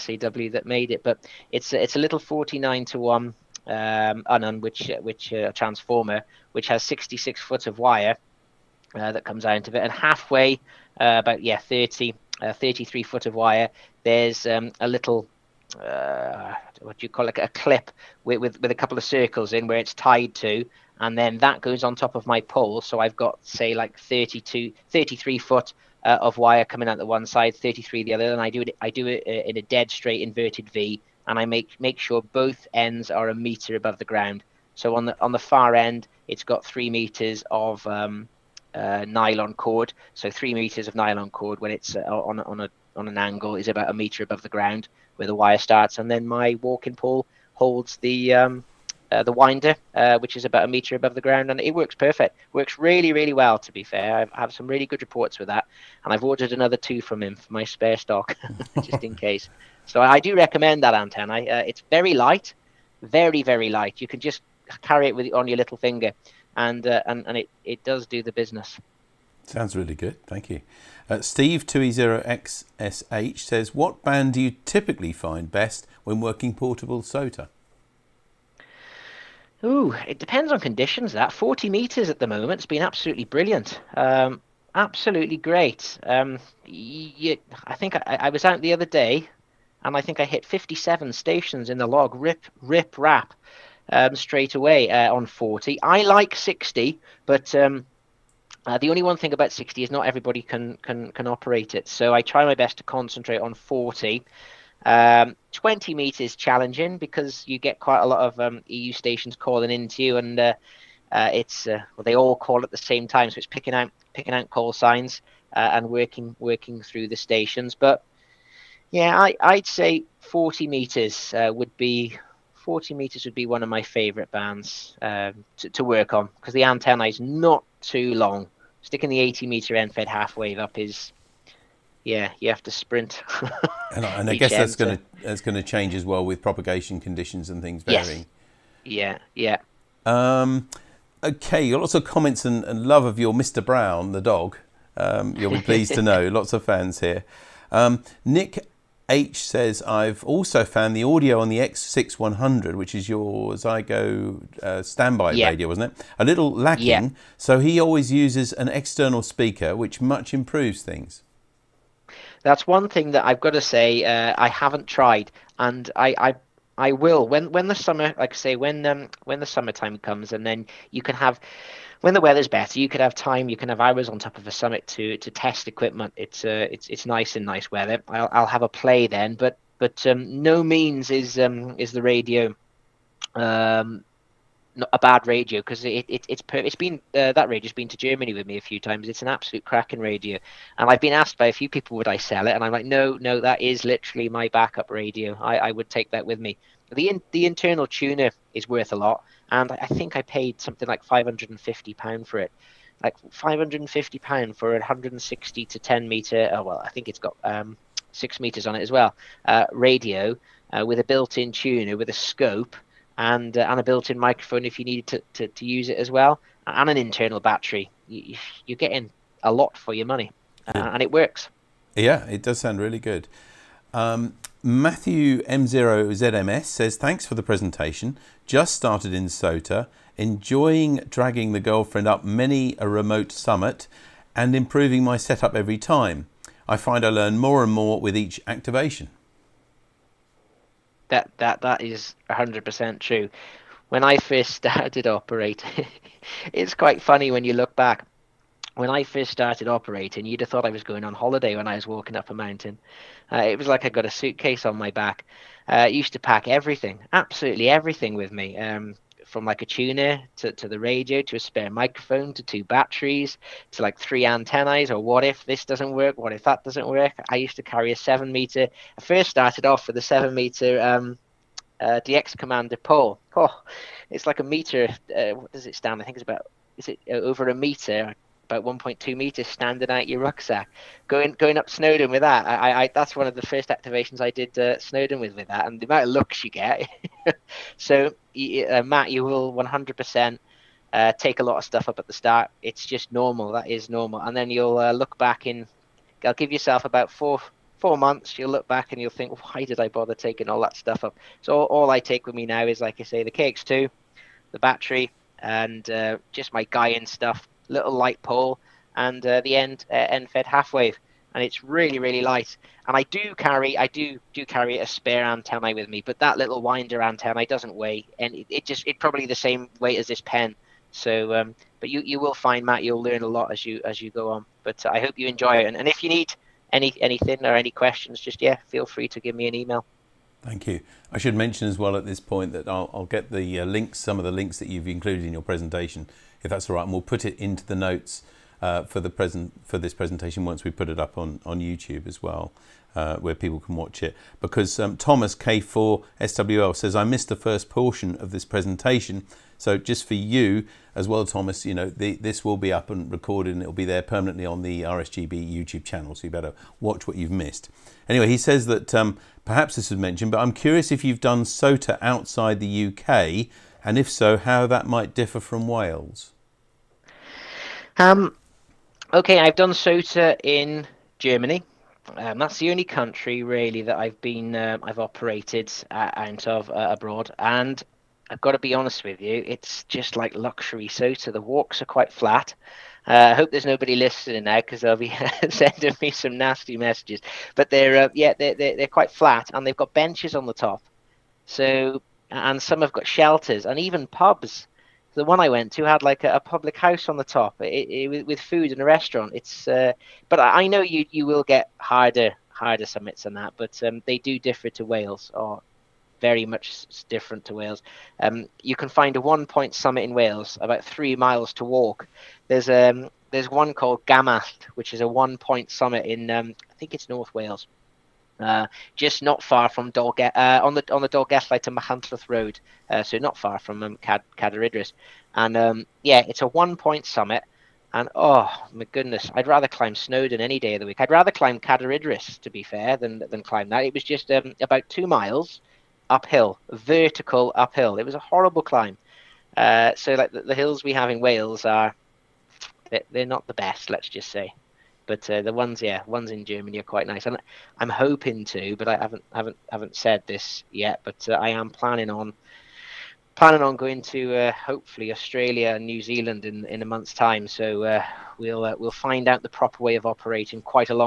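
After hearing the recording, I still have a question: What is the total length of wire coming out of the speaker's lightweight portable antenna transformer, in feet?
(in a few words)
66 feet.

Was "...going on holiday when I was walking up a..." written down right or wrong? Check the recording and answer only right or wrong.
right.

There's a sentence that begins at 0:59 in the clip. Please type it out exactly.
So I do recommend that antenna.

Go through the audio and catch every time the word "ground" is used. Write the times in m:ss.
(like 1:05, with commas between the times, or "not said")
0:34, 0:44, 0:51.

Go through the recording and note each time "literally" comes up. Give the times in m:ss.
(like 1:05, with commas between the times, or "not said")
3:13.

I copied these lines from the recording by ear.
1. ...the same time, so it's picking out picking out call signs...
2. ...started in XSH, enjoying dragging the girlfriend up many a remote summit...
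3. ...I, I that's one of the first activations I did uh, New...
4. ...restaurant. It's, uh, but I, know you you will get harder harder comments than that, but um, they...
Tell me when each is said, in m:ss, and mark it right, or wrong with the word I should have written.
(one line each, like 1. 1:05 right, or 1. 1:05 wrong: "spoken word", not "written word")
1. 1:52 right
2. 3:48 wrong: "SOTA", not "XSH"
3. 4:42 wrong: "Snowdon", not "New"
4. 6:38 wrong: "summits", not "comments".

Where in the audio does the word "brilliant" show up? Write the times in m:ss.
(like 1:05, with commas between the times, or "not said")
1:23.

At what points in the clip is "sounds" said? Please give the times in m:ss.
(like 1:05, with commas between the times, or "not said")
1:09, 3:42.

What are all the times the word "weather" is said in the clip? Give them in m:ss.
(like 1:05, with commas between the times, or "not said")
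2:52, 2:57.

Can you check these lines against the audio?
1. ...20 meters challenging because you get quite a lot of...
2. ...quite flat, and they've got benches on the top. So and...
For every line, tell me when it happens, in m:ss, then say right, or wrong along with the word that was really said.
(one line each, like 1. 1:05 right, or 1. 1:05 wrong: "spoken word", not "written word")
1. 1:45 right
2. 6:28 right.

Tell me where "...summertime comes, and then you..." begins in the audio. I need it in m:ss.
2:49.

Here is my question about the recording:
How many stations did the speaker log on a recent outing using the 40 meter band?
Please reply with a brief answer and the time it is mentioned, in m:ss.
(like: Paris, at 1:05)
57, at 1:30.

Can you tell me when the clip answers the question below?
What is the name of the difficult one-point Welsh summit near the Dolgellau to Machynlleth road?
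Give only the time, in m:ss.
6:54.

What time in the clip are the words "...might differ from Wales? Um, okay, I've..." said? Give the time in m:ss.
6:04.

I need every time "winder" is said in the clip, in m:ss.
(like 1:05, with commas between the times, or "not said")
0:49, 5:16.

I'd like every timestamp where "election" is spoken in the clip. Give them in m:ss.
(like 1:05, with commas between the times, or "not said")
not said.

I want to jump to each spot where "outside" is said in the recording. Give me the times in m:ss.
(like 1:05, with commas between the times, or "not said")
6:02.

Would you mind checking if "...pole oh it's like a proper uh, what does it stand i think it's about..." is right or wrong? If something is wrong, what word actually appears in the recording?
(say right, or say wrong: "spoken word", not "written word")
wrong: "meter", not "proper".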